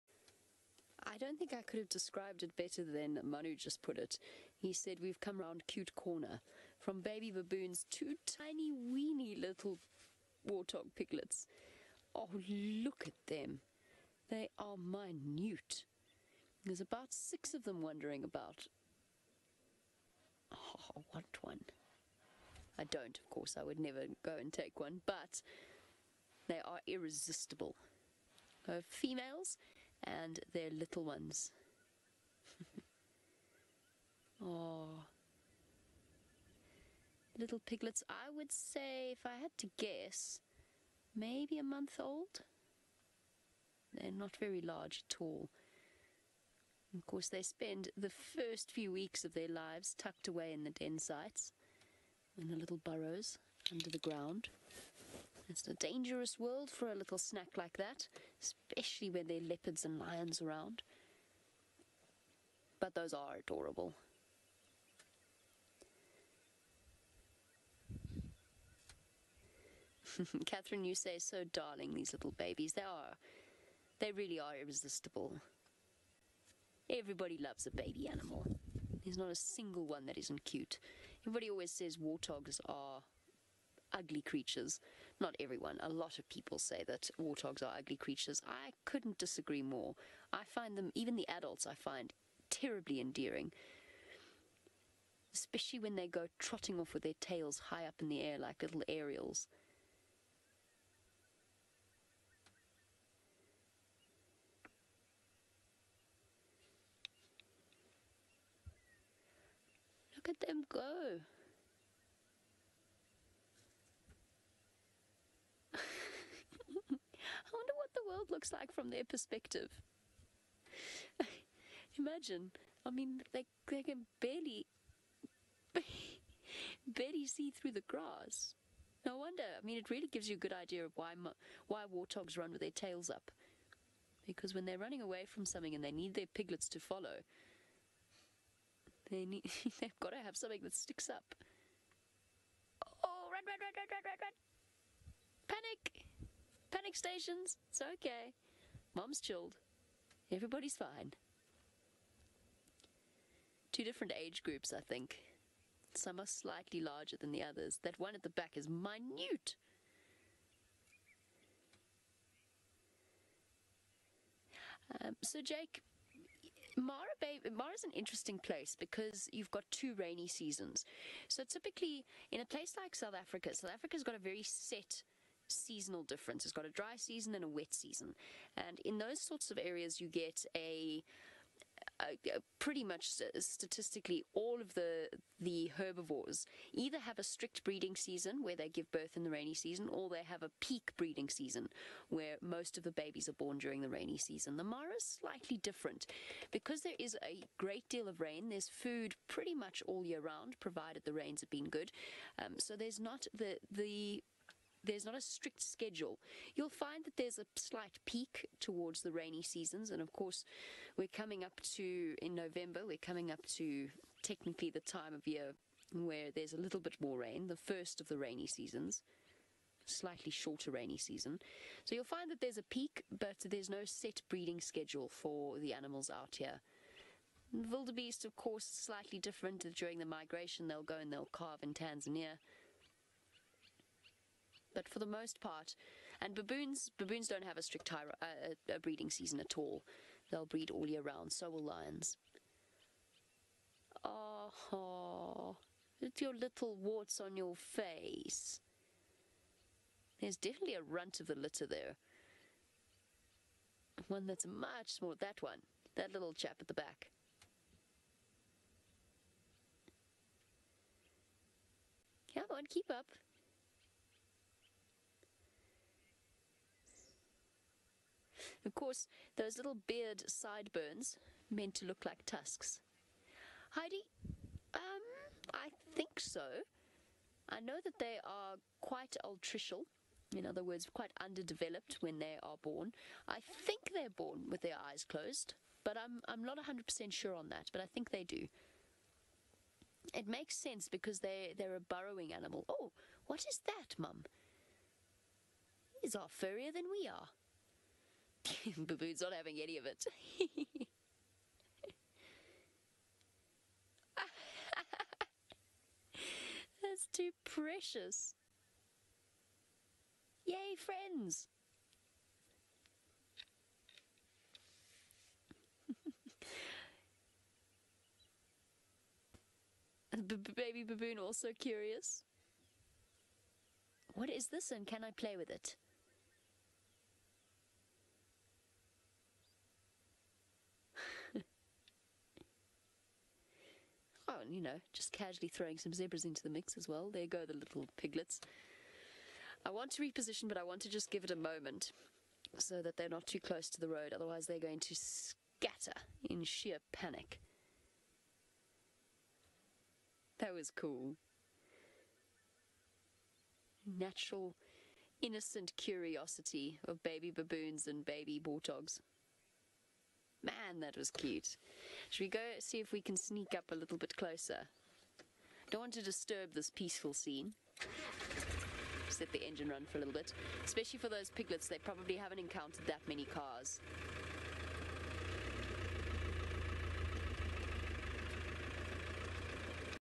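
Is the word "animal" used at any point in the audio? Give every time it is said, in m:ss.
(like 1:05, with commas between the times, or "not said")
1:18, 3:45, 4:52.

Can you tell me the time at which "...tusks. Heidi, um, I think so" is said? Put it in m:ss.
4:32.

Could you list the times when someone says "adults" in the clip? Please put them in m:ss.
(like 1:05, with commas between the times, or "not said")
1:31.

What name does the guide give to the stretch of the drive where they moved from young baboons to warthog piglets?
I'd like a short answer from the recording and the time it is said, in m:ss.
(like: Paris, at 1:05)
Cute Corner, at 0:05.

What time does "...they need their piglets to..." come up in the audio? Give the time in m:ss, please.
2:15.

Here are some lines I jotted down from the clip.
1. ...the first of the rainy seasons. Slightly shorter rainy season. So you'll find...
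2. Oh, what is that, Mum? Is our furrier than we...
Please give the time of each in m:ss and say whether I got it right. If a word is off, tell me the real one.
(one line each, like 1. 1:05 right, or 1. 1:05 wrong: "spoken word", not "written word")
1. 3:37 right
2. 4:52 right.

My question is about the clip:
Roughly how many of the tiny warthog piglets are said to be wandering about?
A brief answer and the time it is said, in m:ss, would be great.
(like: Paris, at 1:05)
6, at 0:17.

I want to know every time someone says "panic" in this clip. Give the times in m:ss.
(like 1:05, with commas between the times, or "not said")
2:26, 5:46.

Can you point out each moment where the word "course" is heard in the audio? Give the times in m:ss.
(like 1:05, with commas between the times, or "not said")
0:23, 0:47, 3:30, 3:48, 4:28.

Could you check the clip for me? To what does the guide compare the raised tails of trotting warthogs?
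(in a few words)
little aerials.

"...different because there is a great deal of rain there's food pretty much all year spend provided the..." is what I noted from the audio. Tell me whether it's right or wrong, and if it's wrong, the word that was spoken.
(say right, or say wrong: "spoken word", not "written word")
wrong: "round", not "spend".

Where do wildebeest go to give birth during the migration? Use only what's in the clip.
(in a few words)
Tanzania.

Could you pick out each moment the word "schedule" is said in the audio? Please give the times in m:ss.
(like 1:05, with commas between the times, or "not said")
3:25, 3:44.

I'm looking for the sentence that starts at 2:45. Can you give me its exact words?
Um, so, Jake, Mara Bay, Mara's an interesting place because you've got two rainy seasons.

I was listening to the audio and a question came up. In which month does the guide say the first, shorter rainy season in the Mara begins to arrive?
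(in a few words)
November.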